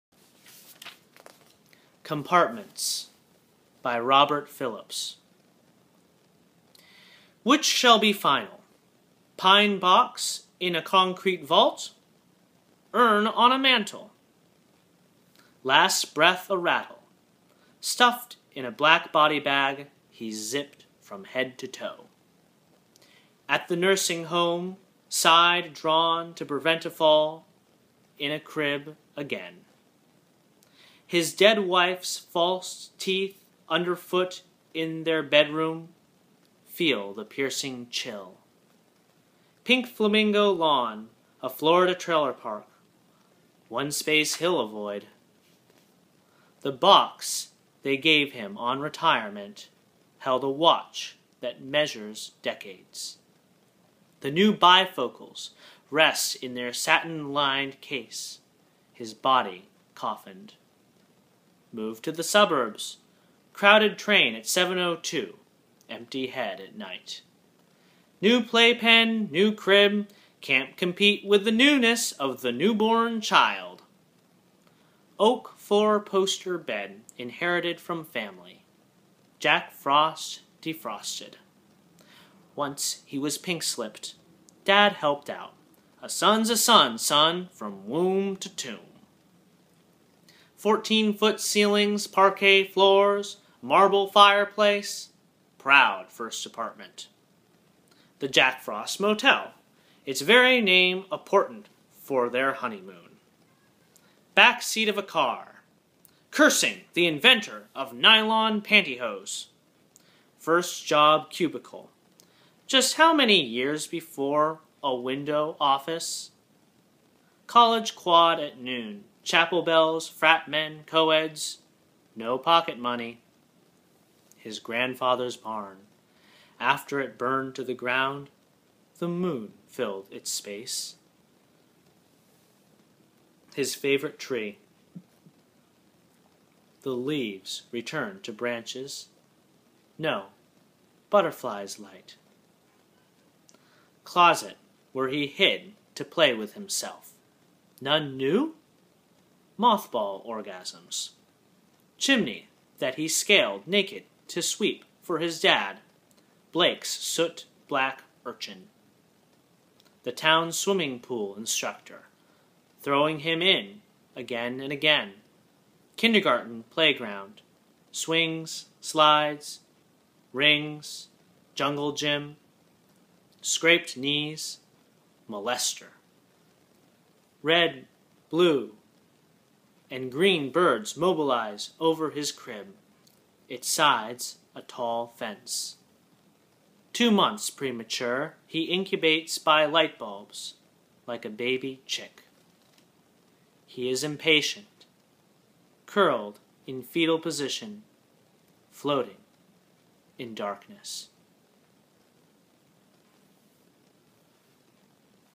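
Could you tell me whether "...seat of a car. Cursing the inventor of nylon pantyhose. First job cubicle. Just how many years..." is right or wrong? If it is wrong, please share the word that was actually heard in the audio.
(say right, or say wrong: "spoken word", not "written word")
right.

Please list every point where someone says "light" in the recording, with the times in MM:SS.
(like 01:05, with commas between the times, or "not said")
02:21, 03:09.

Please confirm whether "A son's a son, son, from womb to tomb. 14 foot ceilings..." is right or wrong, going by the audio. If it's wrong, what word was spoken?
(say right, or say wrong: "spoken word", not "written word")
right.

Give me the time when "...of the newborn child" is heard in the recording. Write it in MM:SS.
01:12.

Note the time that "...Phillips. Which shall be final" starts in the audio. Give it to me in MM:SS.
00:04.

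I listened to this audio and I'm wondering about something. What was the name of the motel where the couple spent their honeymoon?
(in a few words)
The Jack Frost Motel.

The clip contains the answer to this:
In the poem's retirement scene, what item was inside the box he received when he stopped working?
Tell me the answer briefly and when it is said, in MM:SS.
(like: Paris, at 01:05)
a watch, at 00:50.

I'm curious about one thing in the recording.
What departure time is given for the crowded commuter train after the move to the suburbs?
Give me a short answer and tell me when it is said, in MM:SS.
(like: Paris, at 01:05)
7:02, at 01:04.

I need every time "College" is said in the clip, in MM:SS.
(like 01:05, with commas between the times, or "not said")
01:57.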